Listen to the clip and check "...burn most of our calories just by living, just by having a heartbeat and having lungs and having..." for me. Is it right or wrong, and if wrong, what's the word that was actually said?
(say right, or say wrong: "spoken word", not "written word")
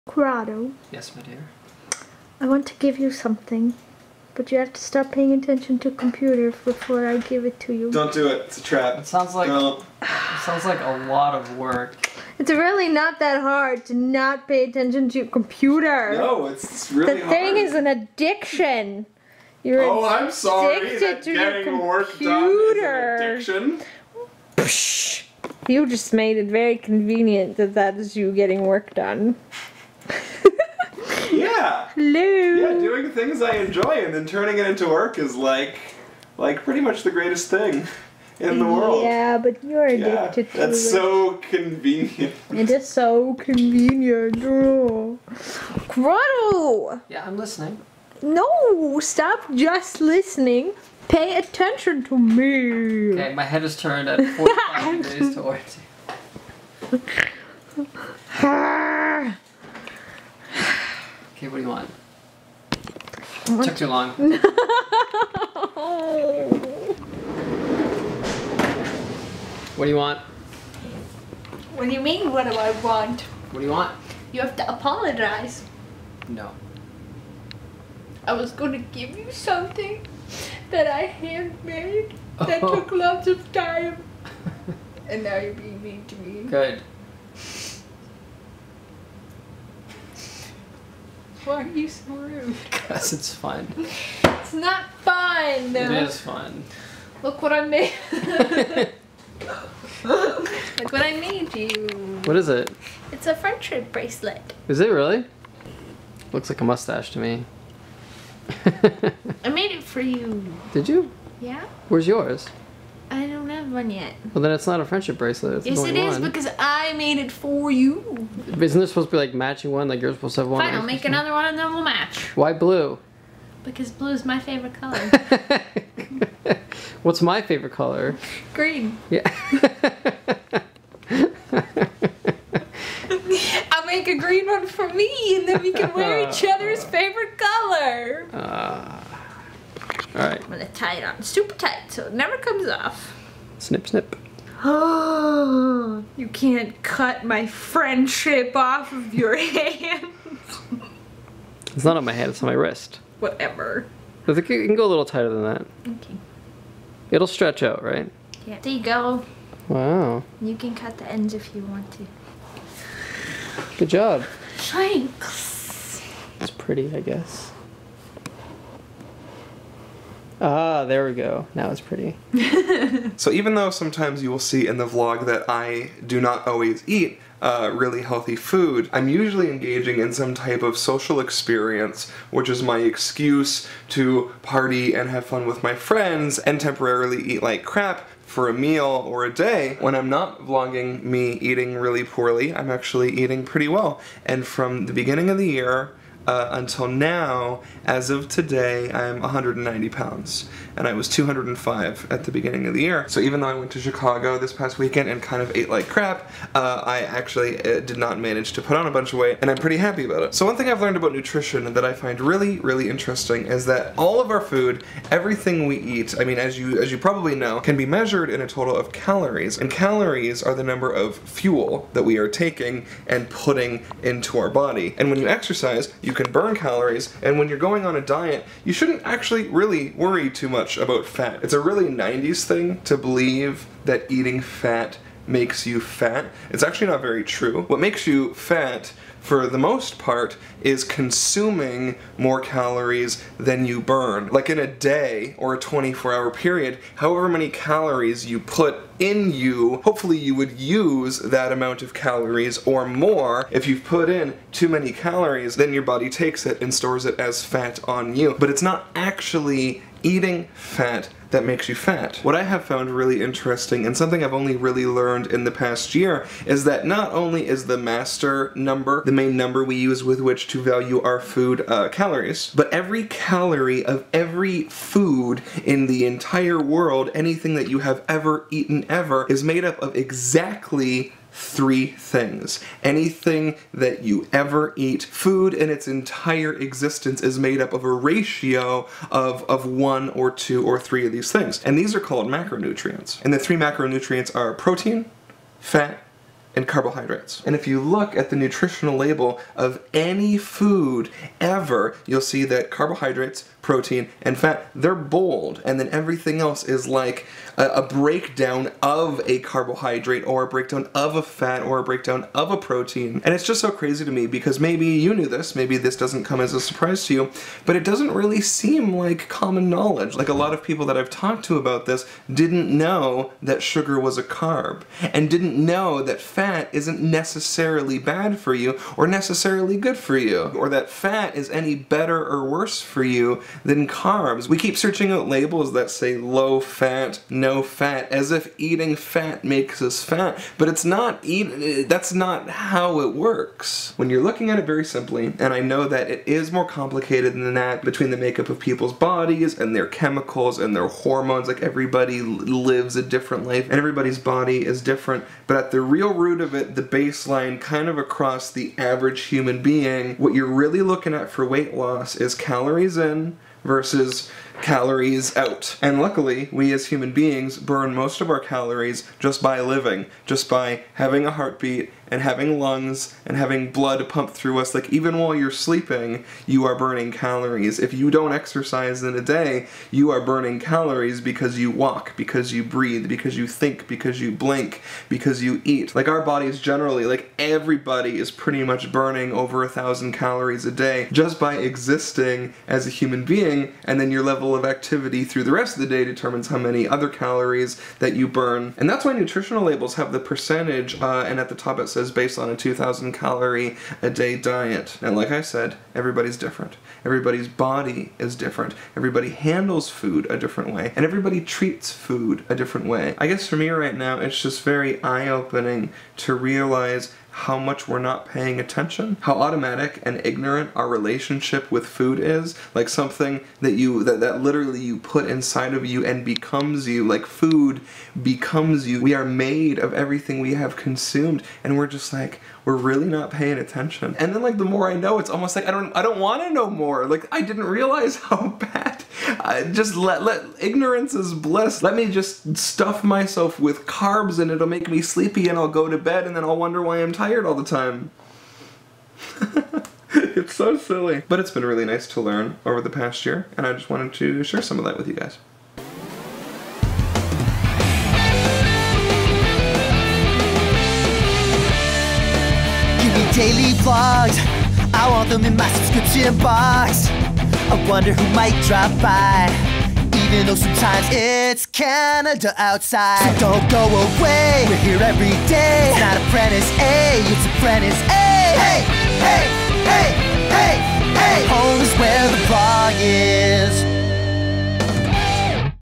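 right.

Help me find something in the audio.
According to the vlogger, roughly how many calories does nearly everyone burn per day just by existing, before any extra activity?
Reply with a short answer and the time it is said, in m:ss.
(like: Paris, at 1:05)
over 1,000, at 6:29.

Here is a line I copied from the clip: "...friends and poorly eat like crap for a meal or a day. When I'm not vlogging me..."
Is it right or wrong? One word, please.
wrong.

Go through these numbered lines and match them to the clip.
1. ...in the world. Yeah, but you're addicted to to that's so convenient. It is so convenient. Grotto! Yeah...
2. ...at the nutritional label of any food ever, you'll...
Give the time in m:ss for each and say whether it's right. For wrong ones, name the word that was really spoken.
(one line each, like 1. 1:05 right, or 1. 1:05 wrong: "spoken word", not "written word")
1. 0:38 right
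2. 4:58 right.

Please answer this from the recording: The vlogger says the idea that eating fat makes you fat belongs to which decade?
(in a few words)
90s.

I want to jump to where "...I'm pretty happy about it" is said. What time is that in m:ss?
3:29.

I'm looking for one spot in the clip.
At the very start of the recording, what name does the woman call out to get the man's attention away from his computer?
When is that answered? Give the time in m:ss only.
0:00.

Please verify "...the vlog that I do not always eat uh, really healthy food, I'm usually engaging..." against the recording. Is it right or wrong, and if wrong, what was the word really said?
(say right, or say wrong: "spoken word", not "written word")
right.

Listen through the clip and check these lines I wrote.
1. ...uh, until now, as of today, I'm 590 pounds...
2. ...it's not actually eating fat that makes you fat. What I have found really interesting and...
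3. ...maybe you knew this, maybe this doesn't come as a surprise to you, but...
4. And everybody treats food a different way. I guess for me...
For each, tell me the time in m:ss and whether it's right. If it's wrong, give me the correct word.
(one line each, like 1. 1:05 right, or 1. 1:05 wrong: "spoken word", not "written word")
1. 3:16 wrong: "190", not "590"
2. 4:18 right
3. 5:14 right
4. 6:50 right.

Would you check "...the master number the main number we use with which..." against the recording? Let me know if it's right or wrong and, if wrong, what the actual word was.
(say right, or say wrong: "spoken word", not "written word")
right.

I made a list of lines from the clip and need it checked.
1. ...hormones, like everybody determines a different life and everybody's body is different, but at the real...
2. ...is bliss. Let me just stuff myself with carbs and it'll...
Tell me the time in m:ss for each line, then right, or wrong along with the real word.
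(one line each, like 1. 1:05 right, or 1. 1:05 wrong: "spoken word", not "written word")
1. 5:50 wrong: "lives", not "determines"
2. 7:21 right.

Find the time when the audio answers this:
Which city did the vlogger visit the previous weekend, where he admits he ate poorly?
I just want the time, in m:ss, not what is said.
3:23.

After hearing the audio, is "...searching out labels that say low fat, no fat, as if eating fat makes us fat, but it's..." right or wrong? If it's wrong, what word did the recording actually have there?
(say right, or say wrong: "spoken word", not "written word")
right.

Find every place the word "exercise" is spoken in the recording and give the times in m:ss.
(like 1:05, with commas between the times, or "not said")
3:45, 6:18.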